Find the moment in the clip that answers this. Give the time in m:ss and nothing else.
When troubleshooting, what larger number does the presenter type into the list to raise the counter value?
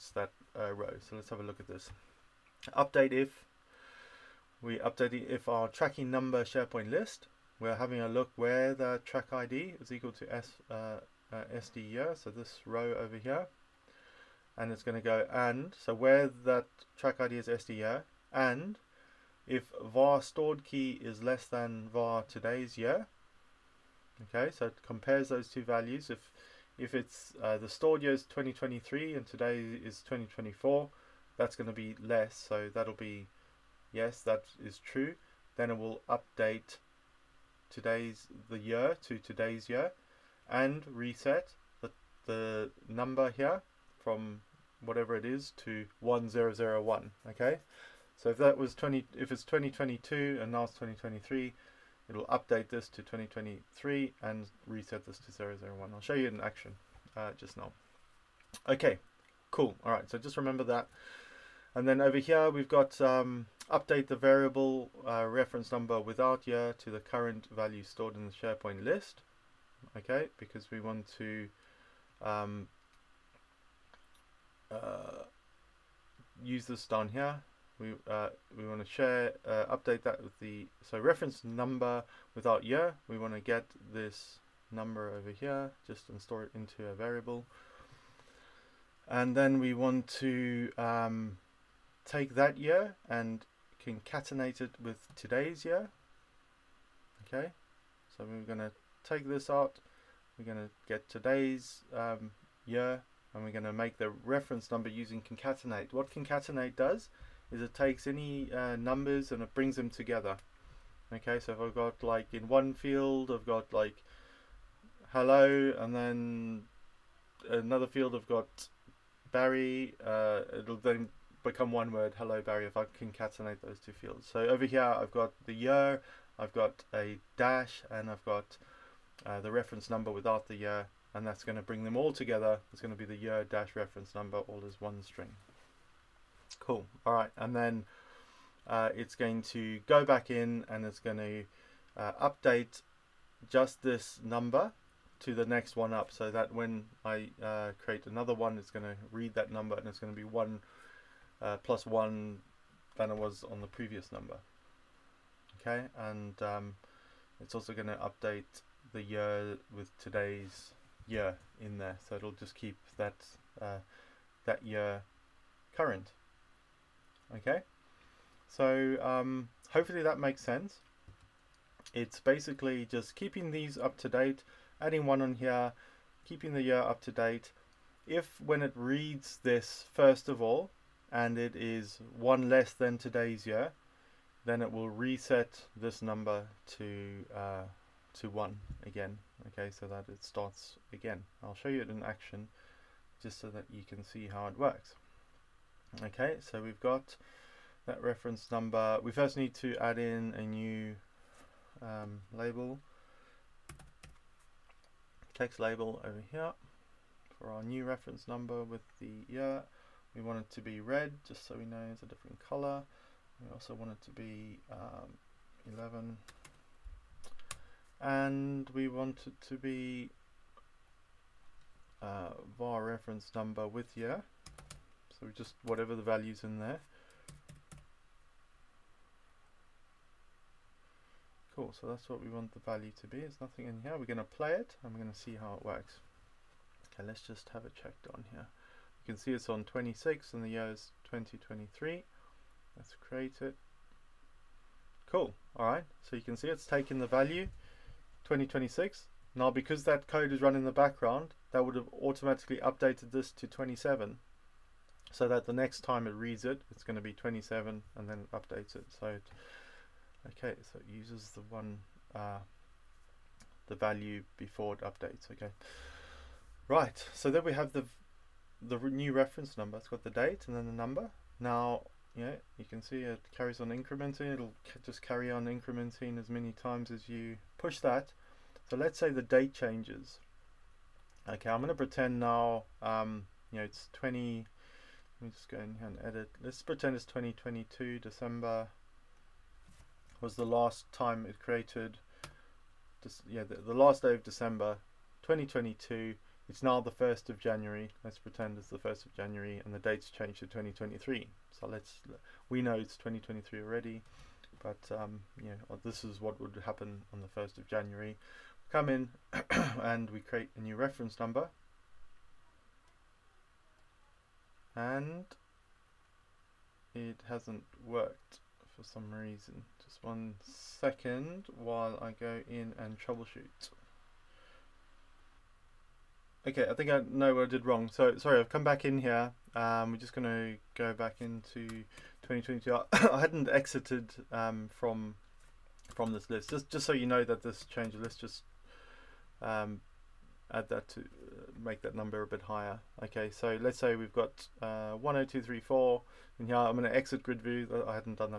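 5:44.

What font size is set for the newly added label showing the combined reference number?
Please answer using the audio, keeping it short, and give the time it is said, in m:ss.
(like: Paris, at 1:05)
11, at 3:35.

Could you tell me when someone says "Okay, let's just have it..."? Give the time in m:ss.
3:56.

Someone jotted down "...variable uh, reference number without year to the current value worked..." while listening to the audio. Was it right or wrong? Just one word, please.
wrong.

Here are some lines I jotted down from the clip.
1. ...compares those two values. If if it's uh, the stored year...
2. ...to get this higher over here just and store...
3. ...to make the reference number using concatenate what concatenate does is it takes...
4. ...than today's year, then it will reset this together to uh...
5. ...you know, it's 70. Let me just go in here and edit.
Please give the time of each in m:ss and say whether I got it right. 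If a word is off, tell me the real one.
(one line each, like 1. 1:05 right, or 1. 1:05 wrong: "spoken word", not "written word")
1. 0:24 right
2. 1:23 wrong: "number", not "higher"
3. 1:43 right
4. 3:02 wrong: "number", not "together"
5. 4:43 wrong: "20", not "70".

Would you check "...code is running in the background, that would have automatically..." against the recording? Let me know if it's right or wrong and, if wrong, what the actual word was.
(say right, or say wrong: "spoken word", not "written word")
right.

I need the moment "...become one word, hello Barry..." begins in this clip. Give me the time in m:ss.
2:01.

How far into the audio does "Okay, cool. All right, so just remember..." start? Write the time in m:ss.
0:58.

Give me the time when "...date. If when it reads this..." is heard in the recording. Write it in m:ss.
2:57.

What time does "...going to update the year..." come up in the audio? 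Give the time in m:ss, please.
2:37.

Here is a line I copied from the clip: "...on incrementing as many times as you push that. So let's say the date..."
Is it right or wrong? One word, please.
right.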